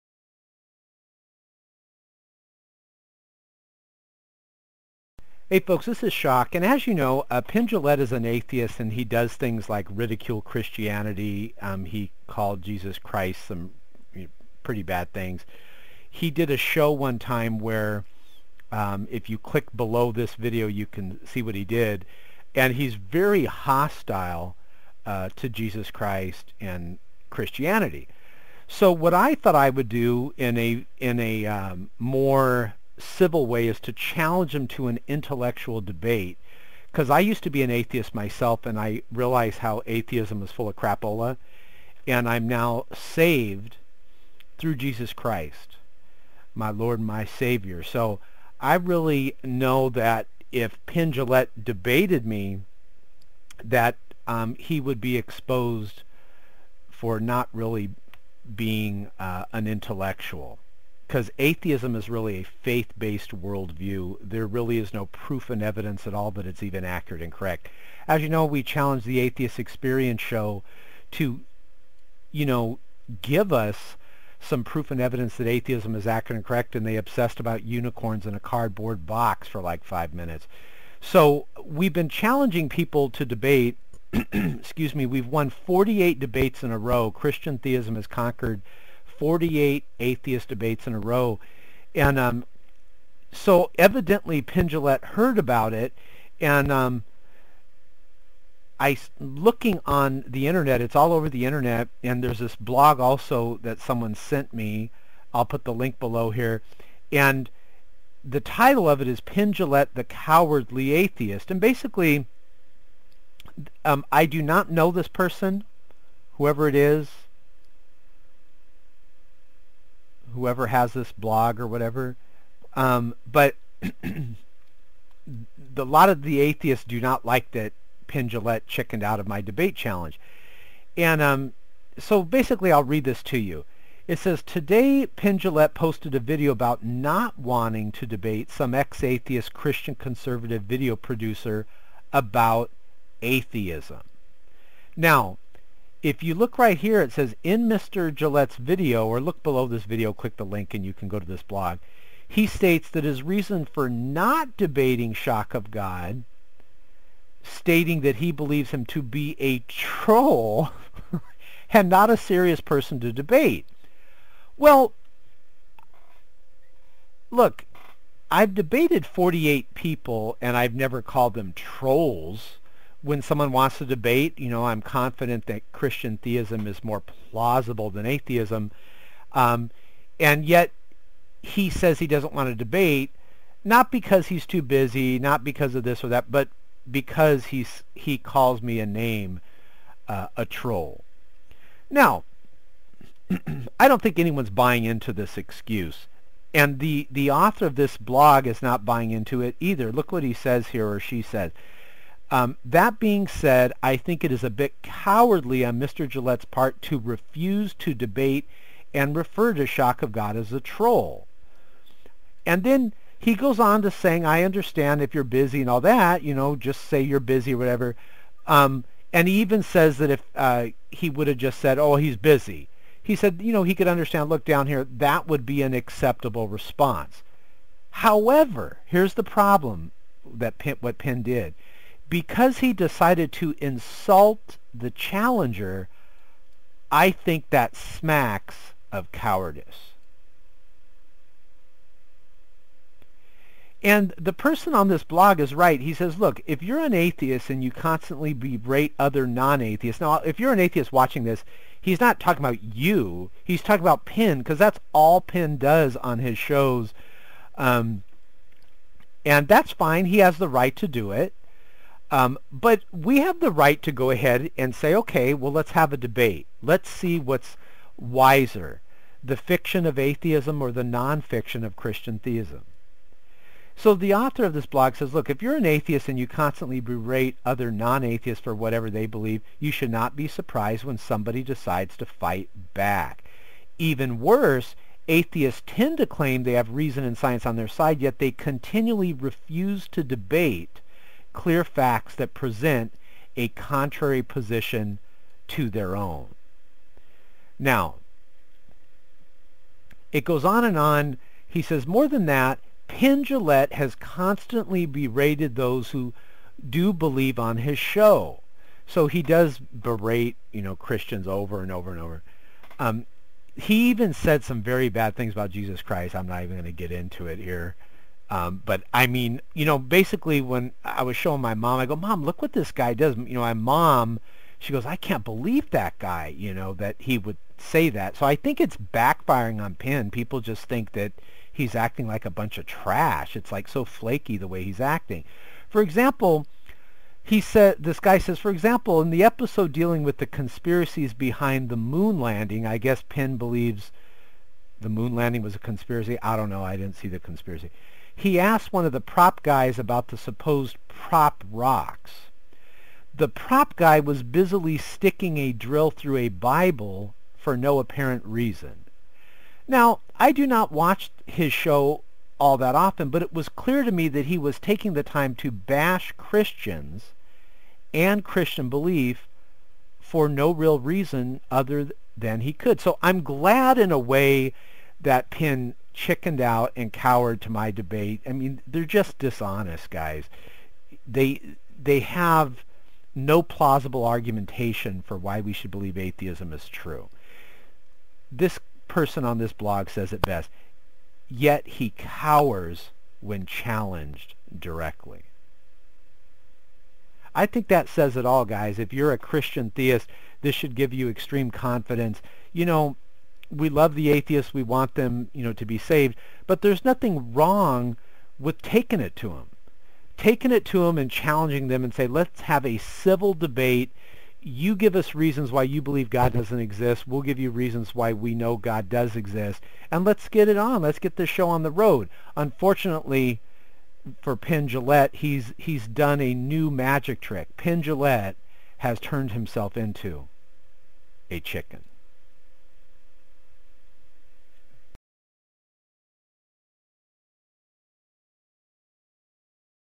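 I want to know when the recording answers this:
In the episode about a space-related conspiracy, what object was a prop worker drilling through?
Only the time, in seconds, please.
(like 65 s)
356 s.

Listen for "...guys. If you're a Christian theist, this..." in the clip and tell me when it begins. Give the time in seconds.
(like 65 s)
398 s.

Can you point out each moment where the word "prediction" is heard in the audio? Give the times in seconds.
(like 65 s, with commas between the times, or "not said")
not said.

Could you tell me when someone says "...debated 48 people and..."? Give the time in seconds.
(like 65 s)
168 s.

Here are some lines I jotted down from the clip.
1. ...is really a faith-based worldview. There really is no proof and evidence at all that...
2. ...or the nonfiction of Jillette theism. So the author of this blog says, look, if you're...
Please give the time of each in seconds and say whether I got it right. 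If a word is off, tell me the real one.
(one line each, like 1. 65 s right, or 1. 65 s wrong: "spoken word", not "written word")
1. 61 s right
2. 270 s wrong: "Christian", not "Jillette".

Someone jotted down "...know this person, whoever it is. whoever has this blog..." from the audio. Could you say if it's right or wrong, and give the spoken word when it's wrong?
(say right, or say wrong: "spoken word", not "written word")
right.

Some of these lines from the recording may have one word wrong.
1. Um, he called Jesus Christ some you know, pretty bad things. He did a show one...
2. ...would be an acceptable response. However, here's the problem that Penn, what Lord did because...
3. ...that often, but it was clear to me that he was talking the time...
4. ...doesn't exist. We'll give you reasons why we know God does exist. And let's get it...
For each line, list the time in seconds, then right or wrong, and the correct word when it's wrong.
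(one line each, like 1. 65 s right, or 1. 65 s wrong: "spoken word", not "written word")
1. 11 s right
2. 225 s wrong: "Penn", not "Lord"
3. 362 s wrong: "taking", not "talking"
4. 416 s right.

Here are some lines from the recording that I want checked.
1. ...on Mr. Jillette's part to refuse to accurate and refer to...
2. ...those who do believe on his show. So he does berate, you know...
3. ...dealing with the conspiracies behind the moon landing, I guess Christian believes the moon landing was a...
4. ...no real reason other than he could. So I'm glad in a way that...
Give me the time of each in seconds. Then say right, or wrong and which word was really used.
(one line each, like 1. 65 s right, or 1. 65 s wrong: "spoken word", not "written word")
1. 205 s wrong: "debate", not "accurate"
2. 305 s right
3. 339 s wrong: "Penn", not "Christian"
4. 370 s right.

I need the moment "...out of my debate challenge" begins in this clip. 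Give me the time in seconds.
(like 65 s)
129 s.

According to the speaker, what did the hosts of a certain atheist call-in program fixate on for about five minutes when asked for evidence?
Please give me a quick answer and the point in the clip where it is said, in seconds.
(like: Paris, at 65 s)
unicorns in a cardboard box, at 77 s.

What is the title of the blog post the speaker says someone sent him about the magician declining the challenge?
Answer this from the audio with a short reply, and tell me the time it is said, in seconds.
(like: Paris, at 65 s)
Penn Jillette the Cowardly Atheist, at 109 s.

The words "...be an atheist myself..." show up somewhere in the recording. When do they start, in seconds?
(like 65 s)
37 s.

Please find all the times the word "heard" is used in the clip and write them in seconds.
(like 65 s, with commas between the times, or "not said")
95 s.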